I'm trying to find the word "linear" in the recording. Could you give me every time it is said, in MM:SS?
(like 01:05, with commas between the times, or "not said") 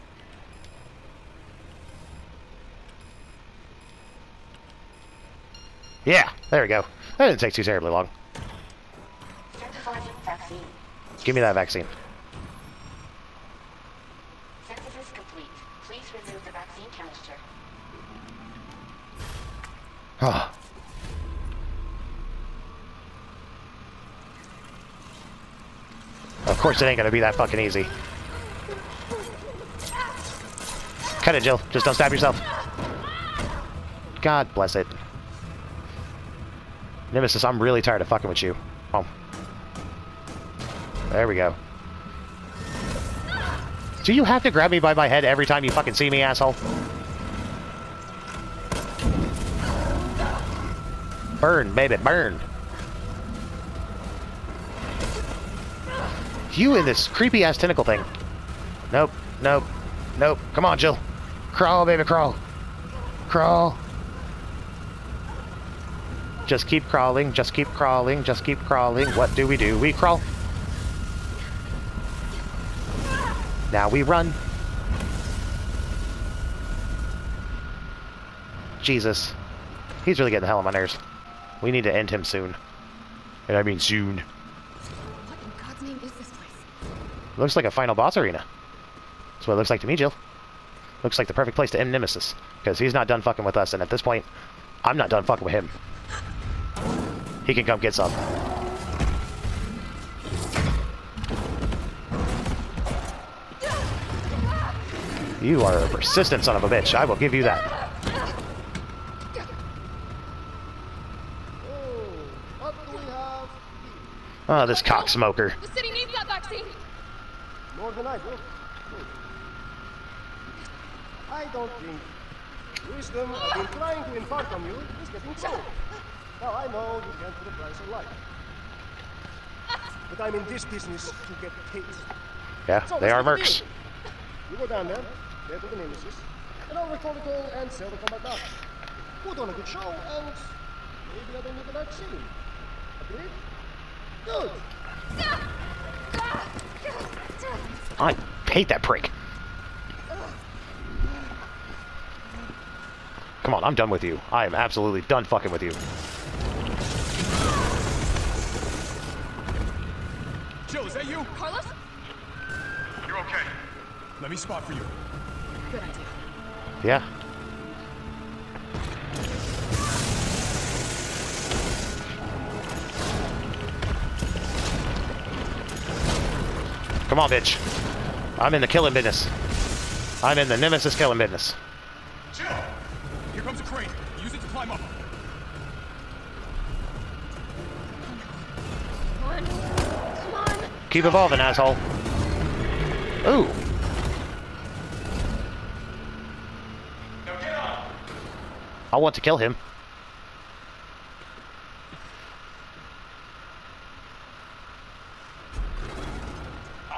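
not said.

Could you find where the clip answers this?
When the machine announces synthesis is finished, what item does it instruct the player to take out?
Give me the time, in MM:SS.
00:16.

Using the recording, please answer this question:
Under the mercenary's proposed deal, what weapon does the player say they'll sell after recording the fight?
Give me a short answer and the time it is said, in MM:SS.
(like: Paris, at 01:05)
Combat knife, at 02:18.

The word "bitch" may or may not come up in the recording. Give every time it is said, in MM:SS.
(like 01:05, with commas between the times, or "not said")
01:46, 02:57.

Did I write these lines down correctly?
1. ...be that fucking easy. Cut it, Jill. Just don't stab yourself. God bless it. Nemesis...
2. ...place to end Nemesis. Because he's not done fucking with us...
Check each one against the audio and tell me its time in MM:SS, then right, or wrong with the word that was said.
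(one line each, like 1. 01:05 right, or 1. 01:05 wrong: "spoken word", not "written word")
1. 00:27 right
2. 01:31 right.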